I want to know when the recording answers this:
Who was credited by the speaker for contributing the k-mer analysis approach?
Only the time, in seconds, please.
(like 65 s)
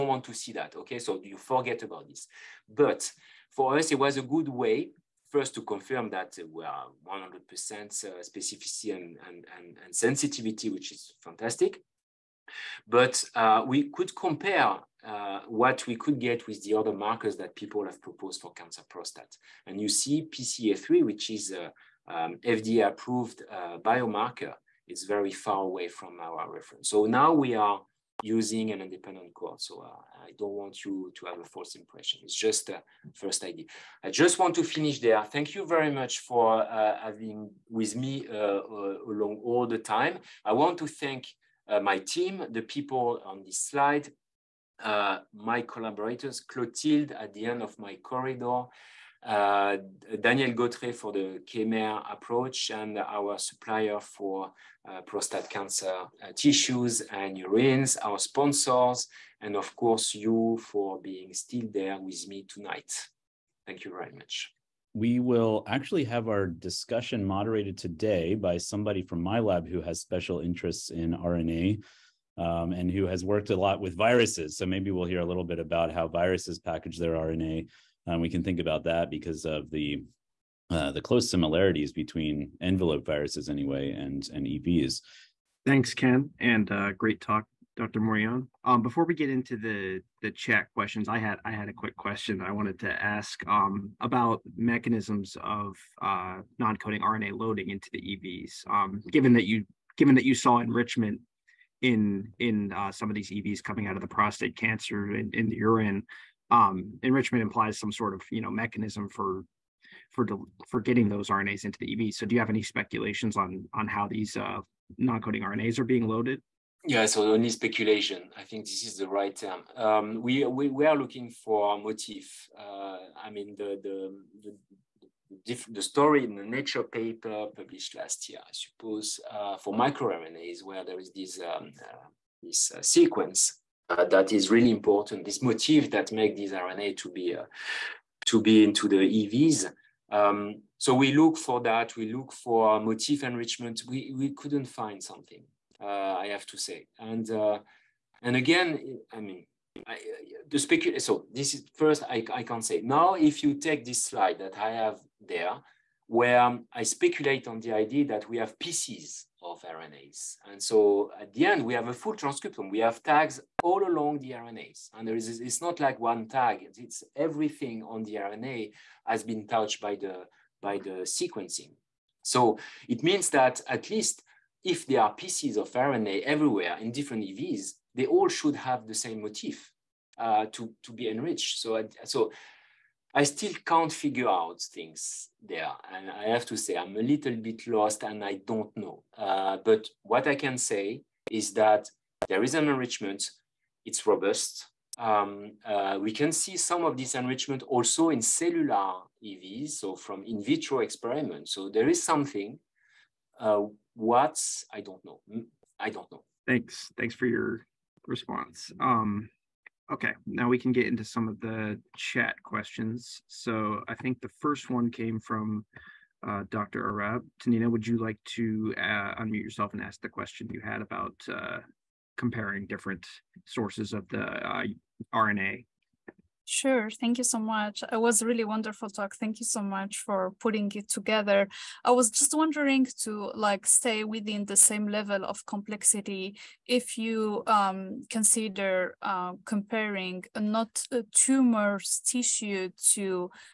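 50 s.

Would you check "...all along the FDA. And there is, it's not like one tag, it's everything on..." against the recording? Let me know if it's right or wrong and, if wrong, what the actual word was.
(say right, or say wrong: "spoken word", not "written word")
wrong: "RNAs", not "FDA".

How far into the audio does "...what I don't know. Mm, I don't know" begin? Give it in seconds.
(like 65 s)
203 s.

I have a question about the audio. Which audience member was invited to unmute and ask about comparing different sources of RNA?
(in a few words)
Dr. Arab.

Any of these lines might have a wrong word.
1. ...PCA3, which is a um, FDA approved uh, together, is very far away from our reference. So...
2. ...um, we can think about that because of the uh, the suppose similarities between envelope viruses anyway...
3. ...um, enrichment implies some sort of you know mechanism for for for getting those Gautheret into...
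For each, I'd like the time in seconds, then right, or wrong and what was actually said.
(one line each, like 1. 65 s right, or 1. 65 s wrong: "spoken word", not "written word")
1. 20 s wrong: "biomarker", not "together"
2. 78 s wrong: "close", not "suppose"
3. 106 s wrong: "RNAs", not "Gautheret".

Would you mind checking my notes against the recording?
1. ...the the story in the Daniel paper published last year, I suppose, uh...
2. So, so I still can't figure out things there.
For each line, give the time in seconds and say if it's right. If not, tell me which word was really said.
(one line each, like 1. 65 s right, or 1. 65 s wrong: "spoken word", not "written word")
1. 125 s wrong: "Nature", not "Daniel"
2. 181 s right.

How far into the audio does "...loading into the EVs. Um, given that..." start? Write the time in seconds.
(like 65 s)
97 s.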